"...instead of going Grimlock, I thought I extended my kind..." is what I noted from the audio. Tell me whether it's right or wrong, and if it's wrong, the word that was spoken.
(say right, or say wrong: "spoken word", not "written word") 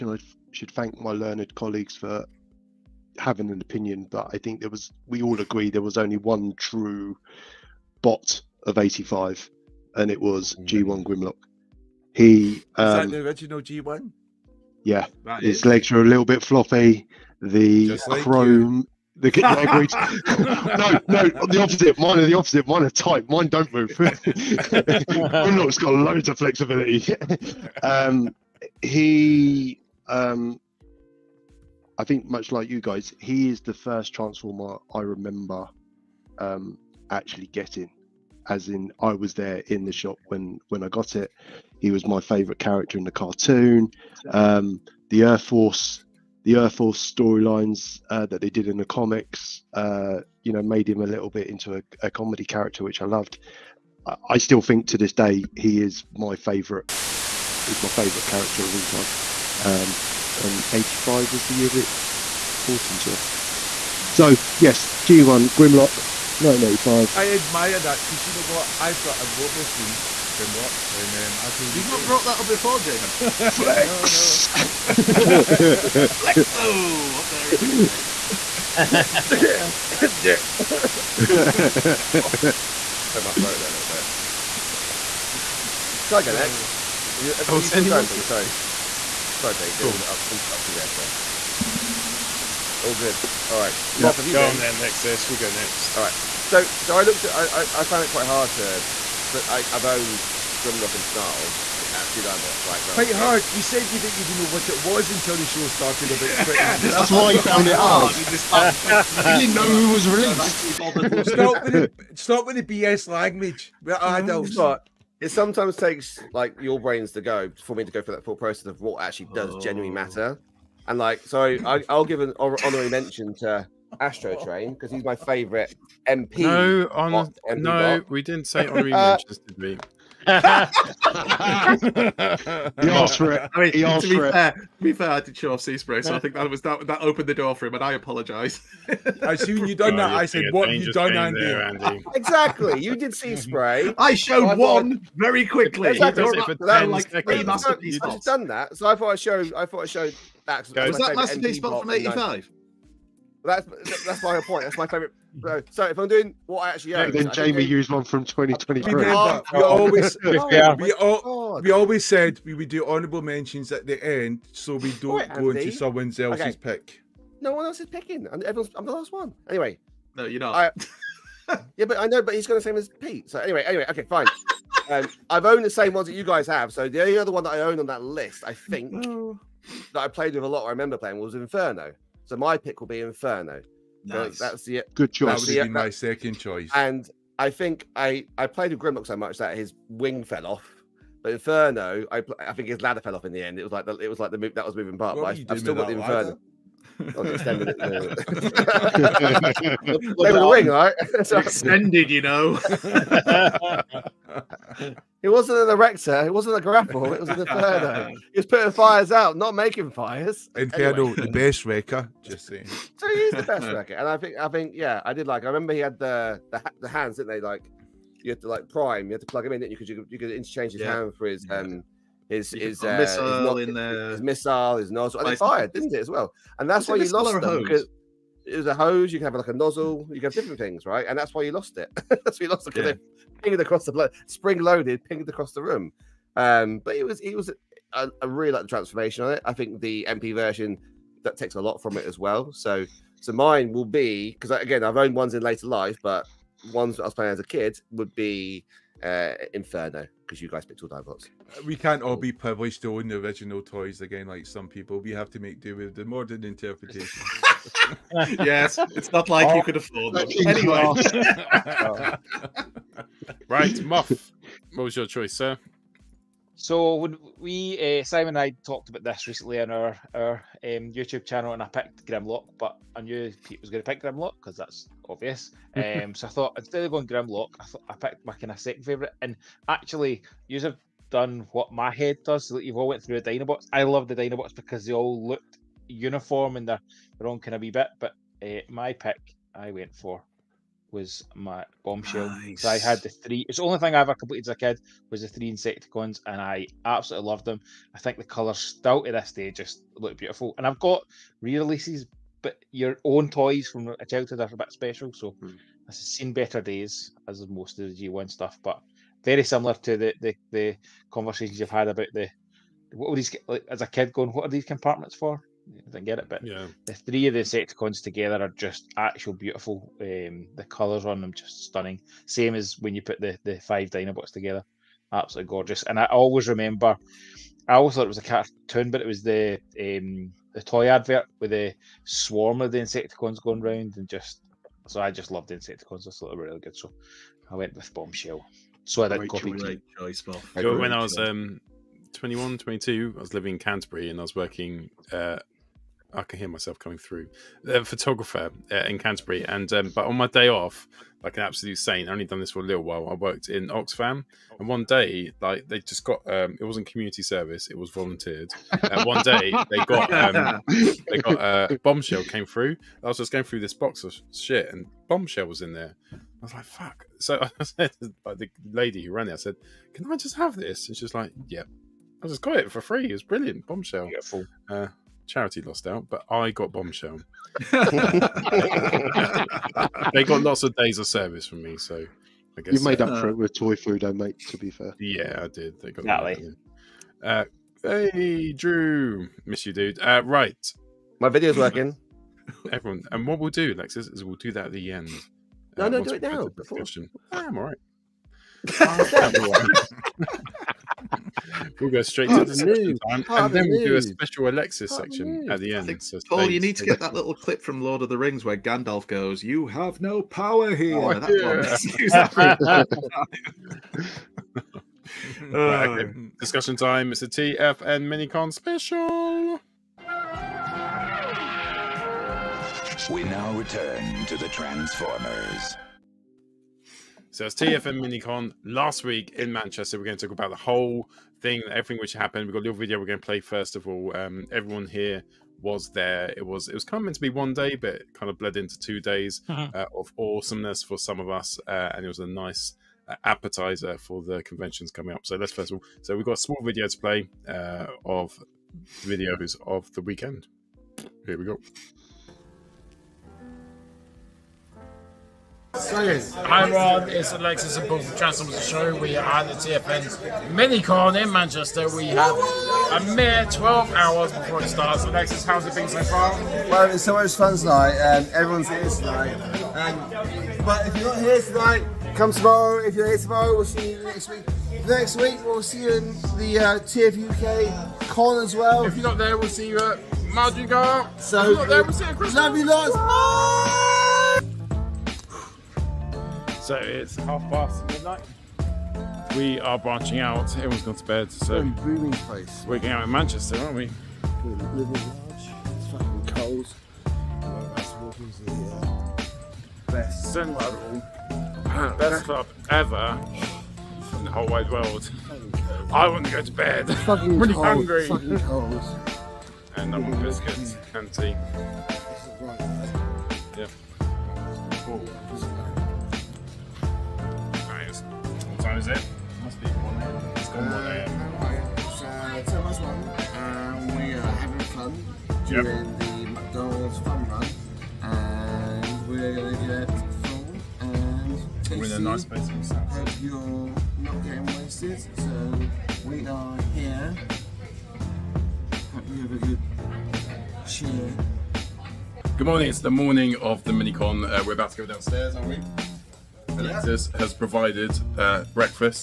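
wrong: "picked", not "extended".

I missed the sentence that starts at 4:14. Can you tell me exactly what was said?
We have to make do with the modern interpretation.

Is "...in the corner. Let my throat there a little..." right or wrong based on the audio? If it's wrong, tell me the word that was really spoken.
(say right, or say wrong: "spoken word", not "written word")
right.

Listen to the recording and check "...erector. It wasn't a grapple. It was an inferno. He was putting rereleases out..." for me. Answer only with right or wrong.
wrong.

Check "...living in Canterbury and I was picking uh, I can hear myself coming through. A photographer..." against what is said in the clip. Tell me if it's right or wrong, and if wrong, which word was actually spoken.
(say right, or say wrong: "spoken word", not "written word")
wrong: "working", not "picking".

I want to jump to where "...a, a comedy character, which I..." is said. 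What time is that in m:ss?
0:51.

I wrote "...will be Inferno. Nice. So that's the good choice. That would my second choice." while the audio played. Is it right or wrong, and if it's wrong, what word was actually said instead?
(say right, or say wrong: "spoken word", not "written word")
right.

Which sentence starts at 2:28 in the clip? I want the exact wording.
I've done that, so I thought I showed.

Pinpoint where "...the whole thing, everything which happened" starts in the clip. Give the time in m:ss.
7:10.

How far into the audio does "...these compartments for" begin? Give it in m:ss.
5:14.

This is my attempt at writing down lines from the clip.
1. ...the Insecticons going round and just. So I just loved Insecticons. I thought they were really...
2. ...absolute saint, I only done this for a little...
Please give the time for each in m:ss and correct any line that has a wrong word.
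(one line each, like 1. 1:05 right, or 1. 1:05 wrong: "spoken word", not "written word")
1. 5:32 right
2. 5:51 right.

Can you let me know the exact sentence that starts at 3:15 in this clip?
but I, have still got the Inferno.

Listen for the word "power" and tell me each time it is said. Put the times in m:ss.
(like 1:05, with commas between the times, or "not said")
6:50.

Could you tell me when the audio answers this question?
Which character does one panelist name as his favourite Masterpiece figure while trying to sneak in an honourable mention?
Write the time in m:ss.
2:04.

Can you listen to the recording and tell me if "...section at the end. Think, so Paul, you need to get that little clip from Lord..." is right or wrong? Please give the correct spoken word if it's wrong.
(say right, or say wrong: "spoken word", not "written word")
right.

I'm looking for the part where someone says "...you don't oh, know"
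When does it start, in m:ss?
2:19.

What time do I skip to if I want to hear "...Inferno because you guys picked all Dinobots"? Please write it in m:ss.
4:09.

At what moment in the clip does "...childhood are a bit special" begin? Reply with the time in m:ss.
5:04.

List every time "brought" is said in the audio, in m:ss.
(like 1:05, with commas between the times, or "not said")
1:02, 1:12.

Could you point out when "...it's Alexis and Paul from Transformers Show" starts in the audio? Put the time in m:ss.
7:37.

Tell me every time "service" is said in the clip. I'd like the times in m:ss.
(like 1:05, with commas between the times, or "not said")
5:57, 6:21.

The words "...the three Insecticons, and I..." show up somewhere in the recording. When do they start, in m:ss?
4:55.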